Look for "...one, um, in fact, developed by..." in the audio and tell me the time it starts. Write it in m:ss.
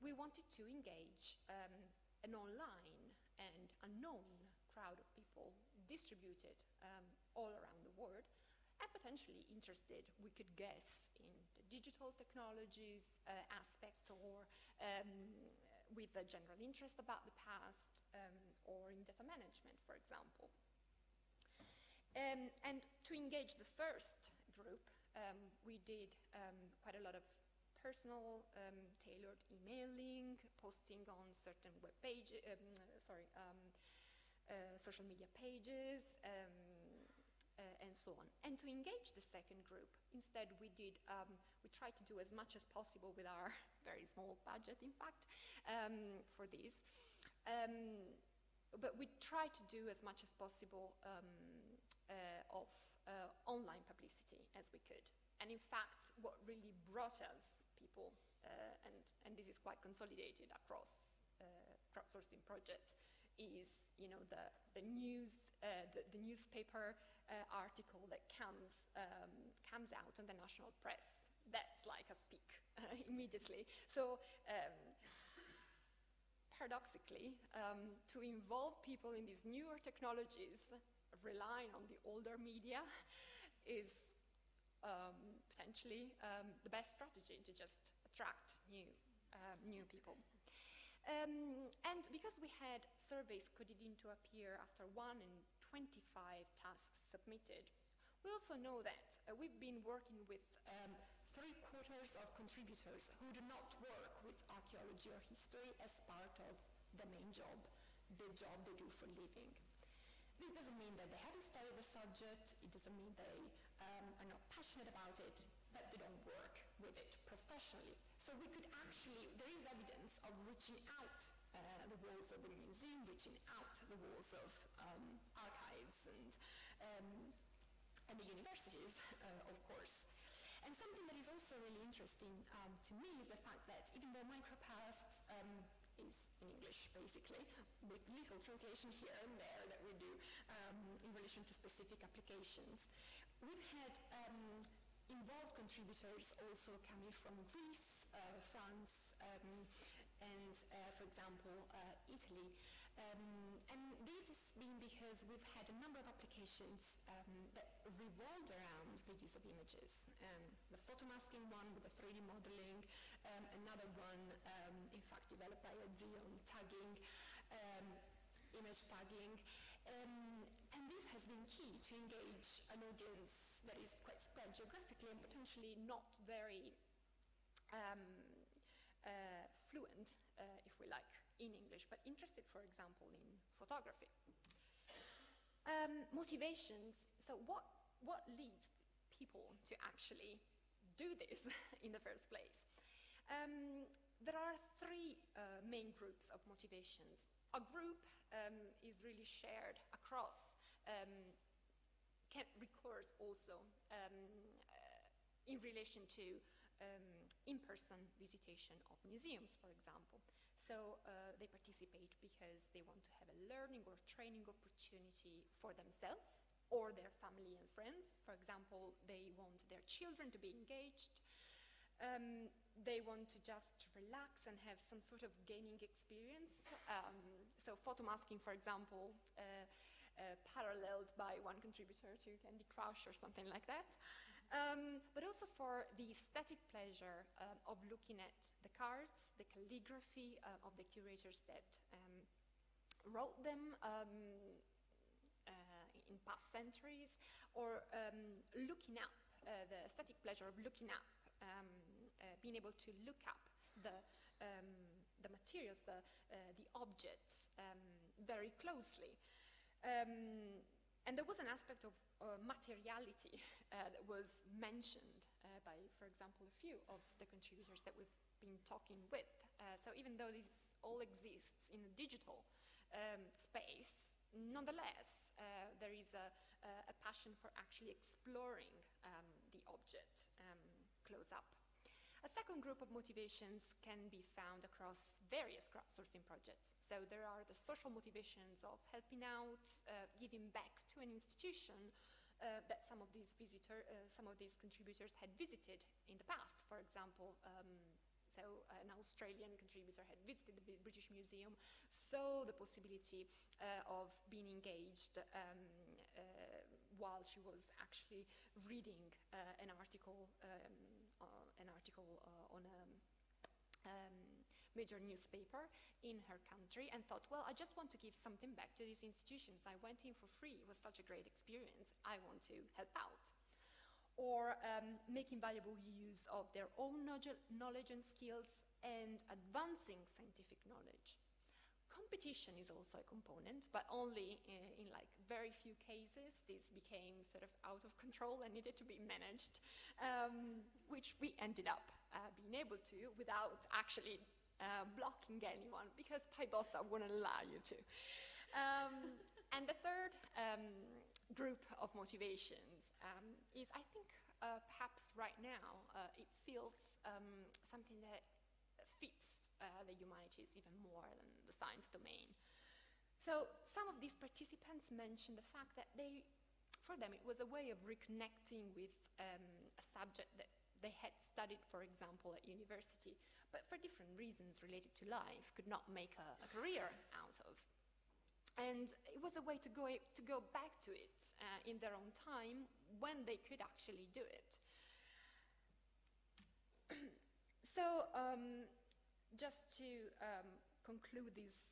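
2:43.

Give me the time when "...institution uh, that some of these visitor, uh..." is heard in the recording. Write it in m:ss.
4:51.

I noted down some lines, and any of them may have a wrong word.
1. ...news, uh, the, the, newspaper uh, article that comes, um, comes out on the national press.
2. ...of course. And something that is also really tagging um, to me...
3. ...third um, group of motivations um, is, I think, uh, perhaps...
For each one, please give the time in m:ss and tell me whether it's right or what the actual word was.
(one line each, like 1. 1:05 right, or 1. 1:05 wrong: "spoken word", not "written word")
1. 1:04 right
2. 2:09 wrong: "interesting", not "tagging"
3. 5:49 right.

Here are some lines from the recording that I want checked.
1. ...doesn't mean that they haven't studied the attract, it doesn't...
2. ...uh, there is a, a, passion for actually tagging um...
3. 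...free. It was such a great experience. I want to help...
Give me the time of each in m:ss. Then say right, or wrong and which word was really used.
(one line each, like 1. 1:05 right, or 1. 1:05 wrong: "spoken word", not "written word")
1. 1:50 wrong: "subject", not "attract"
2. 4:35 wrong: "exploring", not "tagging"
3. 5:20 right.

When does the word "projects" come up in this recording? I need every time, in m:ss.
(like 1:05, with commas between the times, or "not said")
1:02, 4:46.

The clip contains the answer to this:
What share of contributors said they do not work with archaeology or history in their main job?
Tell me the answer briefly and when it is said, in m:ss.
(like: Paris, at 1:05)
three quarters, at 1:41.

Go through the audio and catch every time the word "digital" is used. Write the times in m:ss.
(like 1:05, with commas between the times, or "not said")
0:11, 4:31.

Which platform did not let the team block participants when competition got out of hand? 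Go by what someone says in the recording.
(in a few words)
PyBossa.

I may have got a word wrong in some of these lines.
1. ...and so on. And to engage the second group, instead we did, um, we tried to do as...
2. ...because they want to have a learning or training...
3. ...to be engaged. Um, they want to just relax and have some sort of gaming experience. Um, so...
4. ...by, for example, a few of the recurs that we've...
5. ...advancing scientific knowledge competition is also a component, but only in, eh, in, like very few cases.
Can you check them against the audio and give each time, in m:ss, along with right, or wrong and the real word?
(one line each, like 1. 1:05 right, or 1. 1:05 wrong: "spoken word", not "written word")
1. 0:37 right
2. 3:32 right
3. 3:40 right
4. 4:25 wrong: "contributors", not "recurs"
5. 5:29 right.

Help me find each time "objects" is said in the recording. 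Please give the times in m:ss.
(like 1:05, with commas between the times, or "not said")
4:16, 4:39.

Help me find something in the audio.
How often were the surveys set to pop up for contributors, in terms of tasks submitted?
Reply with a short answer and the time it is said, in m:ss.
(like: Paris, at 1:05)
1 in 25 tasks, at 1:34.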